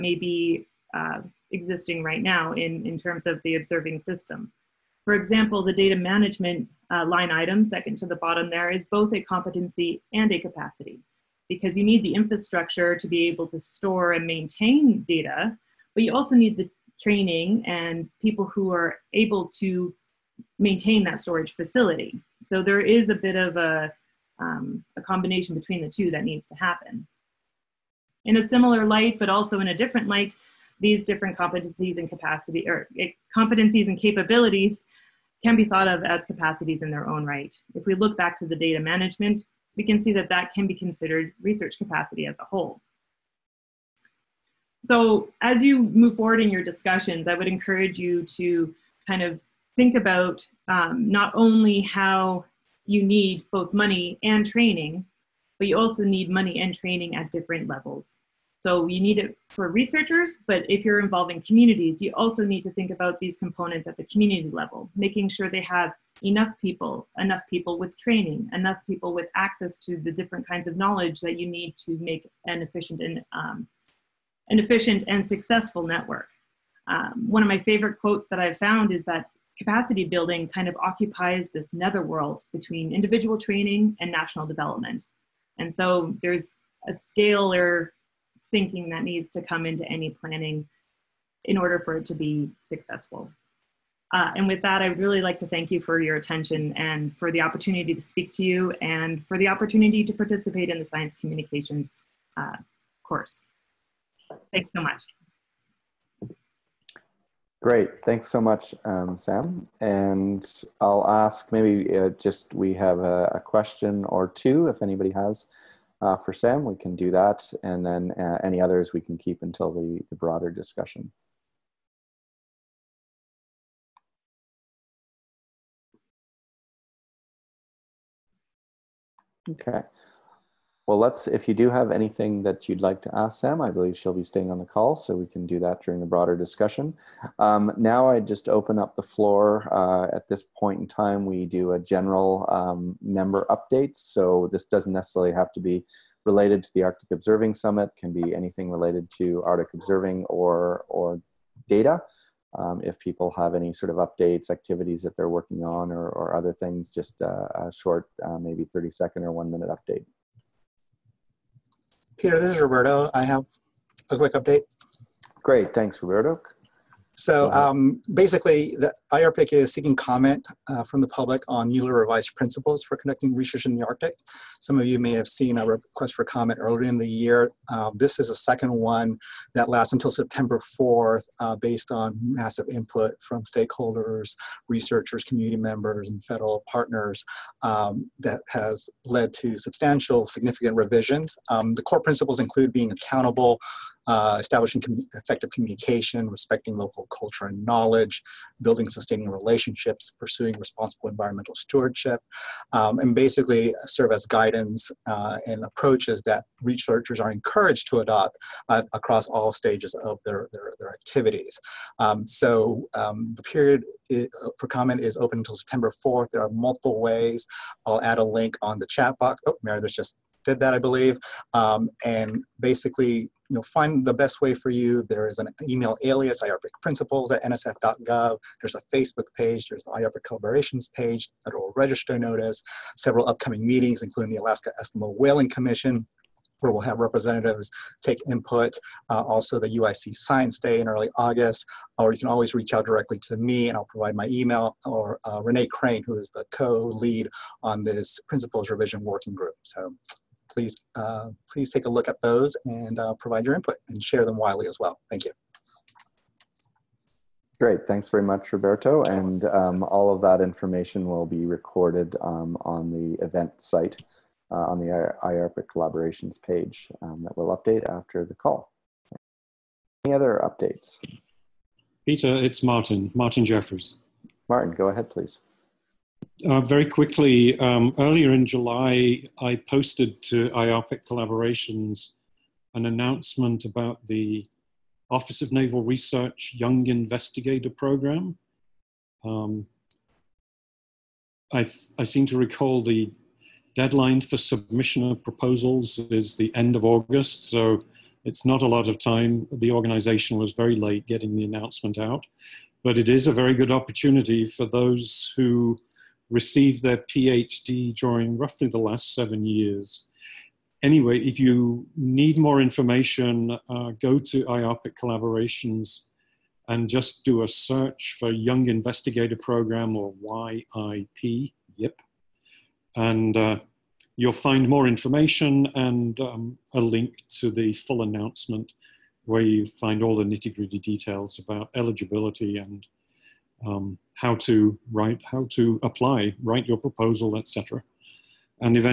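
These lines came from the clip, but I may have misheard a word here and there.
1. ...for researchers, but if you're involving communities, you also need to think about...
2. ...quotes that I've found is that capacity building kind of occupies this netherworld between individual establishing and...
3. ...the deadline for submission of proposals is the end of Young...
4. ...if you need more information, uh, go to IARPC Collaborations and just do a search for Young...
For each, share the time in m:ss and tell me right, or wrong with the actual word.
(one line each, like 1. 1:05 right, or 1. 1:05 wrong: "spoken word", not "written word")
1. 0:59 right
2. 1:18 wrong: "training", not "establishing"
3. 4:52 wrong: "August", not "Young"
4. 5:11 right.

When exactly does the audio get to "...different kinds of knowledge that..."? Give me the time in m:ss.
1:10.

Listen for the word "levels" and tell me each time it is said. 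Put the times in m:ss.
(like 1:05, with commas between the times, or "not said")
0:57, 1:04.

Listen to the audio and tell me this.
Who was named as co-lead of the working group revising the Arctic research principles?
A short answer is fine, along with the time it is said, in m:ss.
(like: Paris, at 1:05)
Renee Crain, at 4:05.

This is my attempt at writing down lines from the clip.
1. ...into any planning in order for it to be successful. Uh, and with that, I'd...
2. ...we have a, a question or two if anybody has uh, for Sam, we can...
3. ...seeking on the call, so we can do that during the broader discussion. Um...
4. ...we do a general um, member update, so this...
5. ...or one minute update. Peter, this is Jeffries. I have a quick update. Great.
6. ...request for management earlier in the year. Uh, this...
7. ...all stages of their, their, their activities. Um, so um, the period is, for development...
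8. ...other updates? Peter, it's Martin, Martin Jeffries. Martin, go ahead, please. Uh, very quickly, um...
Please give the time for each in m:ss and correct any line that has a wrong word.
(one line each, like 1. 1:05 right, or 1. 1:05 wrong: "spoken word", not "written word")
1. 1:29 right
2. 1:52 right
3. 2:14 wrong: "staying", not "seeking"
4. 2:21 right
5. 2:39 wrong: "Roberto", not "Jeffries"
6. 2:55 wrong: "comment", not "management"
7. 3:29 wrong: "comment", not "development"
8. 4:30 right.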